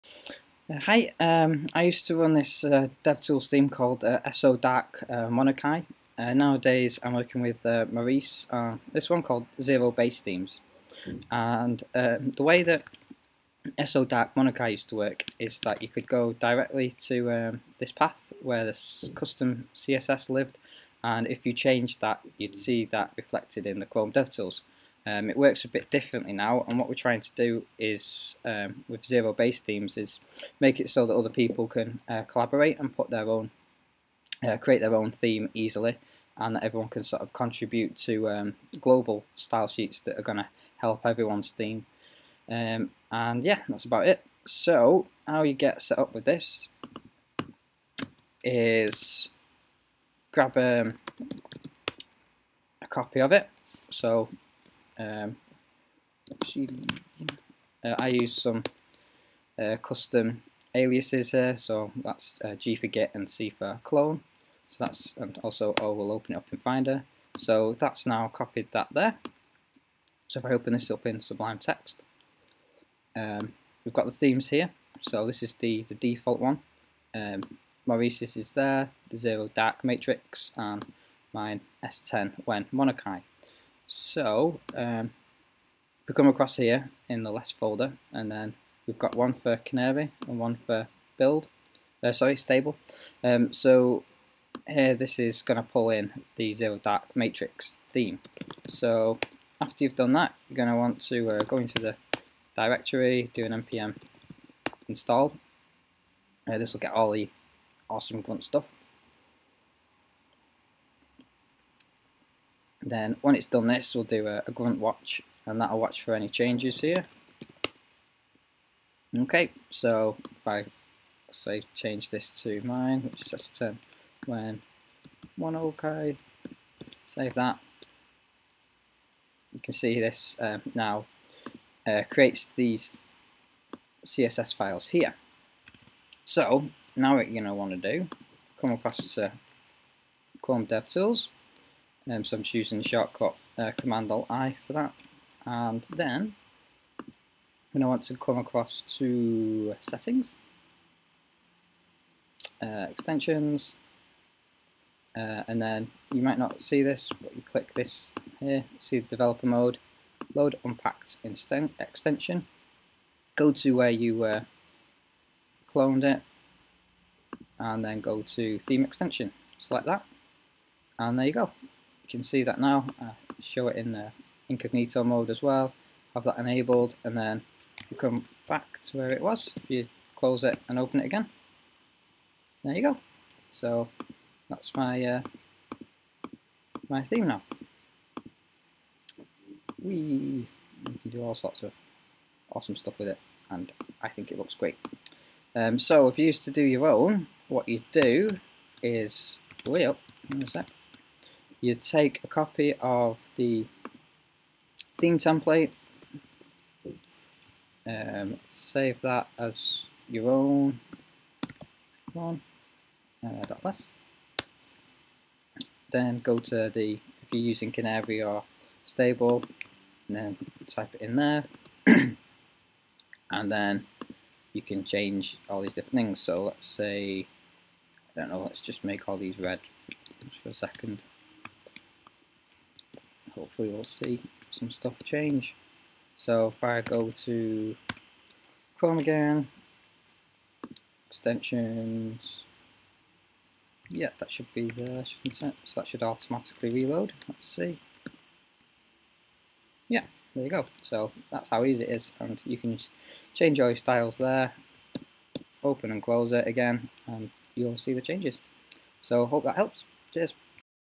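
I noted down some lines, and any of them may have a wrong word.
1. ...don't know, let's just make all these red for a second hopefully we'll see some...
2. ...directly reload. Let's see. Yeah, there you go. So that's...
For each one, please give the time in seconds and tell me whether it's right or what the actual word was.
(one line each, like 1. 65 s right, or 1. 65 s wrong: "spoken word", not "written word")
1. 228 s right
2. 246 s wrong: "automatically", not "directly".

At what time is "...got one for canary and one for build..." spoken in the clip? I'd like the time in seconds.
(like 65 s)
88 s.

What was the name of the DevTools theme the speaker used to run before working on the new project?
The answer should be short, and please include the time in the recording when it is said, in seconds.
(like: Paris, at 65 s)
SO Dark Monokai, at 4 s.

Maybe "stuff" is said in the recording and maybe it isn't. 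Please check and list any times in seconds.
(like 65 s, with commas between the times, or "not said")
108 s, 192 s, 234 s.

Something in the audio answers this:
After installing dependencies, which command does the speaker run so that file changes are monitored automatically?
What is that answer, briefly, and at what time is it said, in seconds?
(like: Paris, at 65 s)
grunt watch, at 114 s.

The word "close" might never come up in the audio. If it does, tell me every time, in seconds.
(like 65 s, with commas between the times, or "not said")
180 s, 256 s.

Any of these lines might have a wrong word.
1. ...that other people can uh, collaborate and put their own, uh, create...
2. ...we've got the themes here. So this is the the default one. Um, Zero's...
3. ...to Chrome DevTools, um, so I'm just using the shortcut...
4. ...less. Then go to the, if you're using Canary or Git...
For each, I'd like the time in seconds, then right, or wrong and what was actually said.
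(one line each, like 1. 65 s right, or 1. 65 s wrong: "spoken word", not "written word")
1. 31 s right
2. 73 s wrong: "Maurice", not "Zero"
3. 139 s right
4. 213 s wrong: "Stable", not "Git".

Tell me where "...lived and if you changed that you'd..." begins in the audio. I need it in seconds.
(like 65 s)
20 s.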